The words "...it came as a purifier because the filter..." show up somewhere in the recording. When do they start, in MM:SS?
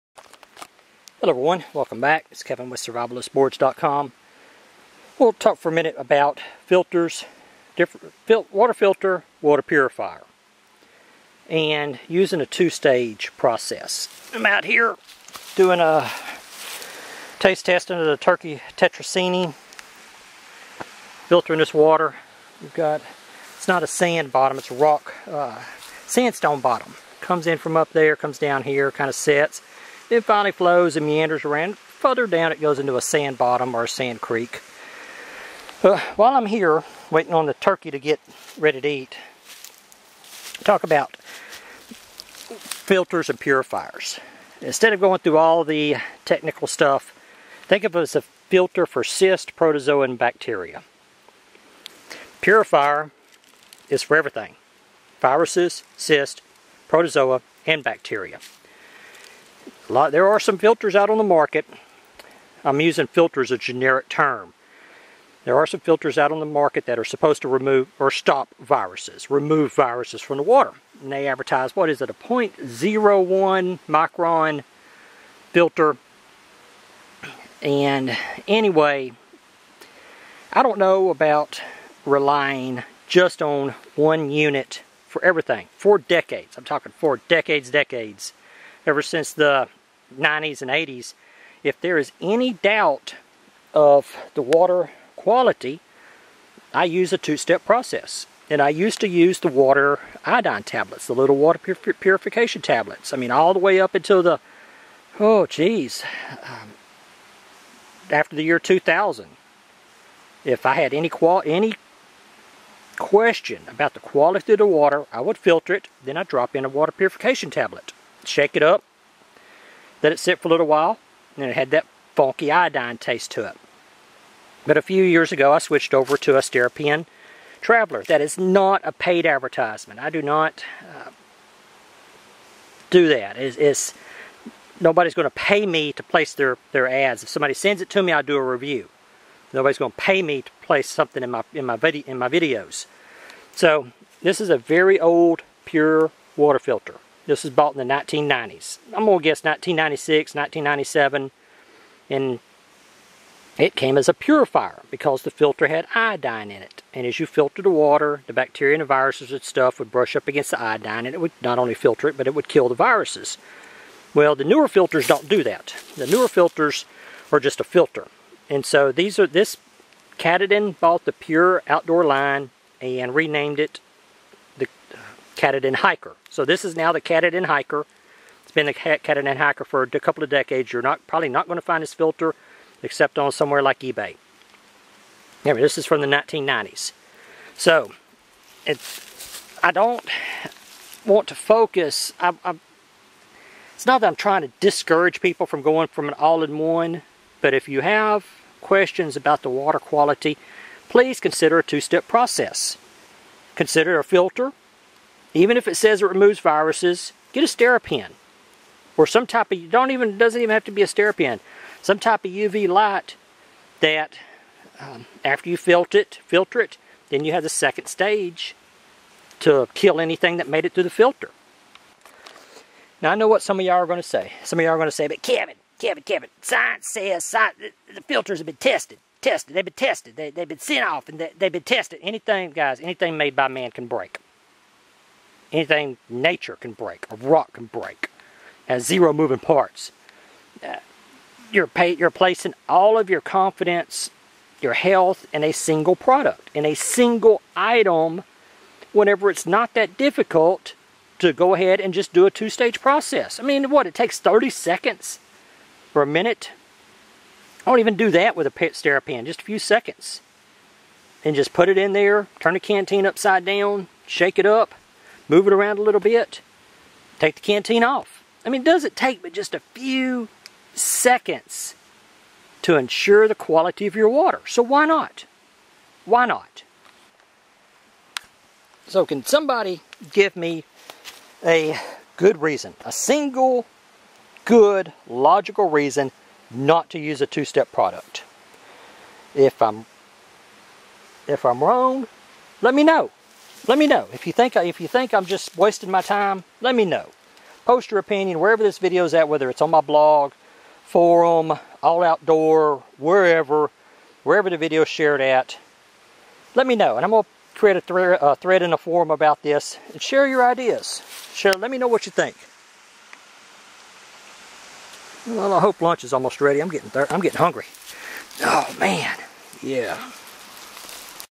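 02:33.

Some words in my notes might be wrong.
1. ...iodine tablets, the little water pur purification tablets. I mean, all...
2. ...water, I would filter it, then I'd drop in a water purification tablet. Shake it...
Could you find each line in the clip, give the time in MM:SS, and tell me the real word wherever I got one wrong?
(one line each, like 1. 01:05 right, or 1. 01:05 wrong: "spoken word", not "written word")
1. 01:40 right
2. 01:54 right.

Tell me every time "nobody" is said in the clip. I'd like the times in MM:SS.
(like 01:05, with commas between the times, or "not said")
02:14, 02:19.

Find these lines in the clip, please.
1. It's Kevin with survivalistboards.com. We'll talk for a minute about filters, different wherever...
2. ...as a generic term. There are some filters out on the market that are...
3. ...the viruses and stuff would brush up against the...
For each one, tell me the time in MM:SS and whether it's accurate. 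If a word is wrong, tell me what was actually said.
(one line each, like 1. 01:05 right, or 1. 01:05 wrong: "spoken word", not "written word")
1. 00:02 wrong: "water", not "wherever"
2. 01:03 right
3. 02:38 right.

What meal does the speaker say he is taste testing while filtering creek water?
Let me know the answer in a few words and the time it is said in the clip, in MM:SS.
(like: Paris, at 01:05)
Turkey tetrazzini, at 00:18.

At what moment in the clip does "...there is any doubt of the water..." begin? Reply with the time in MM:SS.
01:31.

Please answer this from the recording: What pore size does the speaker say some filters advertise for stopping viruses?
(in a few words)
0.01 micron.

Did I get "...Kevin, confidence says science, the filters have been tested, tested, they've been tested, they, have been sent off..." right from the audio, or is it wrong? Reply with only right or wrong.
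wrong.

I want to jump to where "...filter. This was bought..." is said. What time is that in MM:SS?
02:26.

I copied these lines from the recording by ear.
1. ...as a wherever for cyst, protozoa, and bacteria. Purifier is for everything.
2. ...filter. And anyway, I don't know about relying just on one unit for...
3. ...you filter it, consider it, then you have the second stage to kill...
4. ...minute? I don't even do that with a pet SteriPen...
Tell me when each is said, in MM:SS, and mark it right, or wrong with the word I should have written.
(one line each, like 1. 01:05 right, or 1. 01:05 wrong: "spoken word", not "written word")
1. 00:48 wrong: "filter", not "wherever"
2. 01:15 right
3. 03:35 wrong: "filter", not "consider"
4. 04:16 right.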